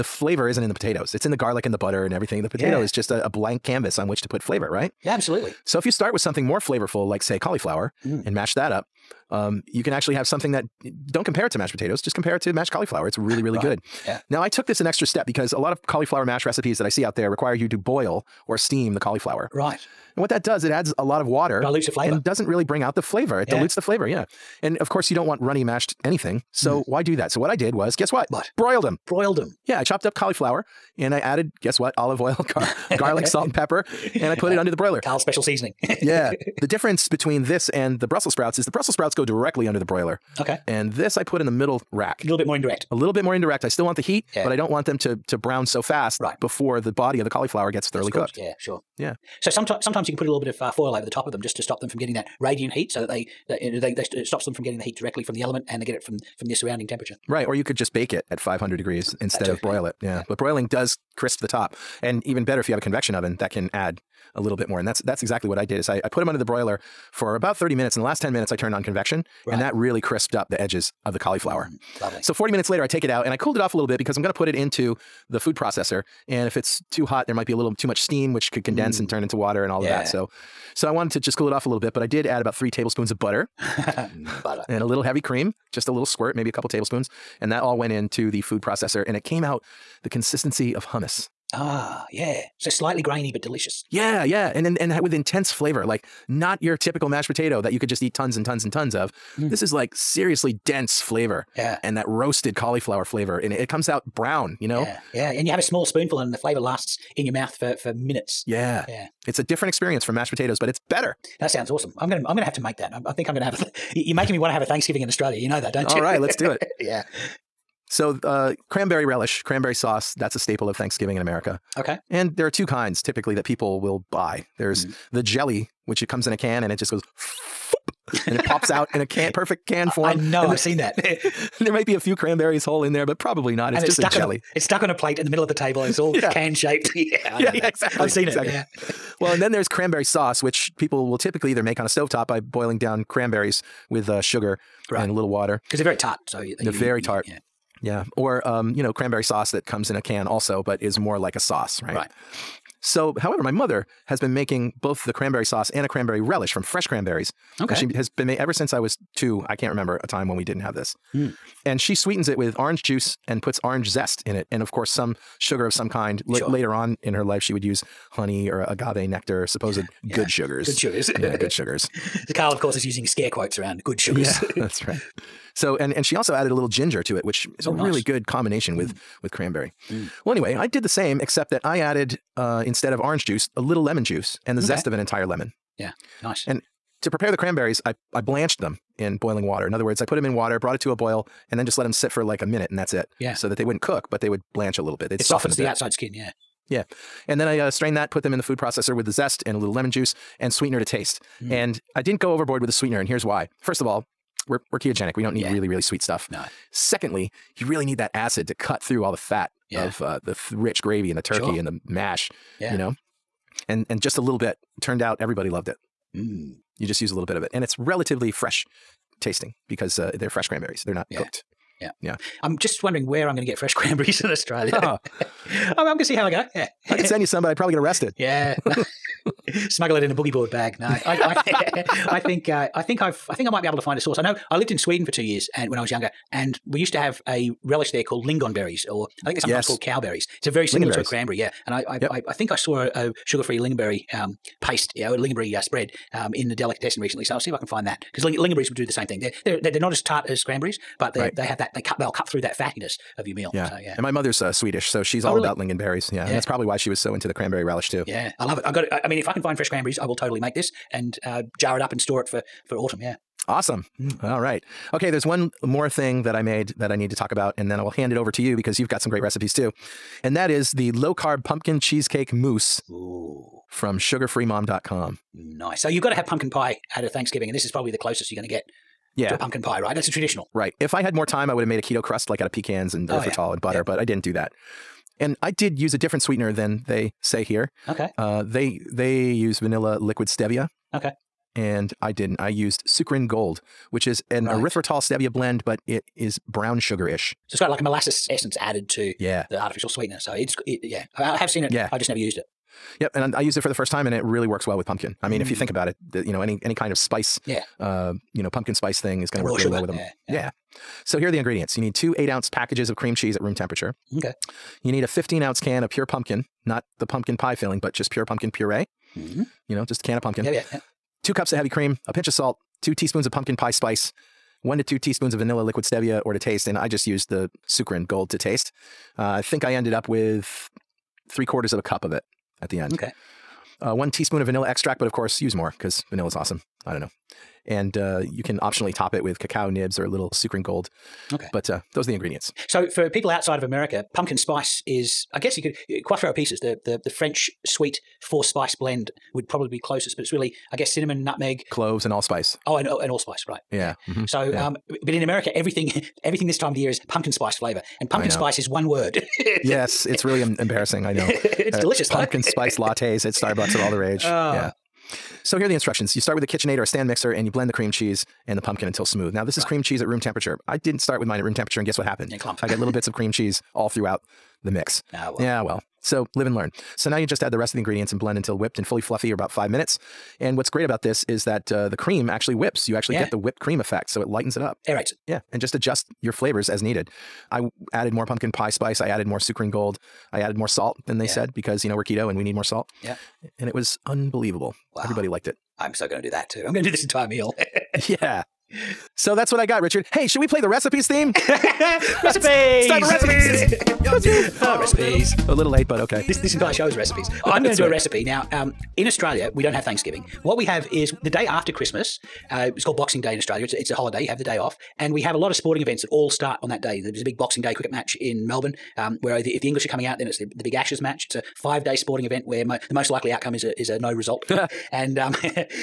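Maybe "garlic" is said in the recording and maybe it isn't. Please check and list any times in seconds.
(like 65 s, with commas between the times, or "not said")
1 s, 32 s.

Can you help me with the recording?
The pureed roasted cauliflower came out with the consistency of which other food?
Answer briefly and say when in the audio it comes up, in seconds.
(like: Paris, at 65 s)
Hummus, at 90 s.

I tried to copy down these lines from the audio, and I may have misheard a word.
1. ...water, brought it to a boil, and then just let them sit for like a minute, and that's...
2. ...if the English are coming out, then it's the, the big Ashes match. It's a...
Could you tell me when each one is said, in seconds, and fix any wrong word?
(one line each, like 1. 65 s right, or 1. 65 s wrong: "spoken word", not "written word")
1. 190 s right
2. 419 s right.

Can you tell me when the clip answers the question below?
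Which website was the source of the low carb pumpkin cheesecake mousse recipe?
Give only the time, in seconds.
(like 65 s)
273 s.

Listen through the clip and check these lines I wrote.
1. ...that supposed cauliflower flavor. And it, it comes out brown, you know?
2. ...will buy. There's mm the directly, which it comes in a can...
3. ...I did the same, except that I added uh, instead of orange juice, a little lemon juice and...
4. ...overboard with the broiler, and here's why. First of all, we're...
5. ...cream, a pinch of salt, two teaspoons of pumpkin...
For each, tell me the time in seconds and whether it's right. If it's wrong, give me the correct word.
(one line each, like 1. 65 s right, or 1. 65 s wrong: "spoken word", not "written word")
1. 101 s wrong: "roasted", not "supposed"
2. 123 s wrong: "jelly", not "directly"
3. 180 s right
4. 202 s wrong: "sweetener", not "broiler"
5. 321 s right.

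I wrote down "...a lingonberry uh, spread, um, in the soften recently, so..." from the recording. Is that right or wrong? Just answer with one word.
wrong.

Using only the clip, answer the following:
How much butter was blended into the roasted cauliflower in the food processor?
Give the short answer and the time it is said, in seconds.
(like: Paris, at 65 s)
3 tablespoons, at 82 s.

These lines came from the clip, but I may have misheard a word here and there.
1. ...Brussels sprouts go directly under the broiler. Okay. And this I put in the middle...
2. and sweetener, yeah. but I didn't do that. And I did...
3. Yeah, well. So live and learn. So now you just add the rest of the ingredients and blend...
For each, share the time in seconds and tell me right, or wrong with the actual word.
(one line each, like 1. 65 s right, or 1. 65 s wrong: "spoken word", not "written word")
1. 38 s right
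2. 283 s wrong: "butter", not "sweetener"
3. 375 s right.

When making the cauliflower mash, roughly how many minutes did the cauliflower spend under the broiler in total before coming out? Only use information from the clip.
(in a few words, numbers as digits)
40.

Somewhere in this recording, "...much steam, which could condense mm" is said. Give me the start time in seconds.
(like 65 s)
77 s.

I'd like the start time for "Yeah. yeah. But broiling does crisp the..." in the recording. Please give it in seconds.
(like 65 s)
60 s.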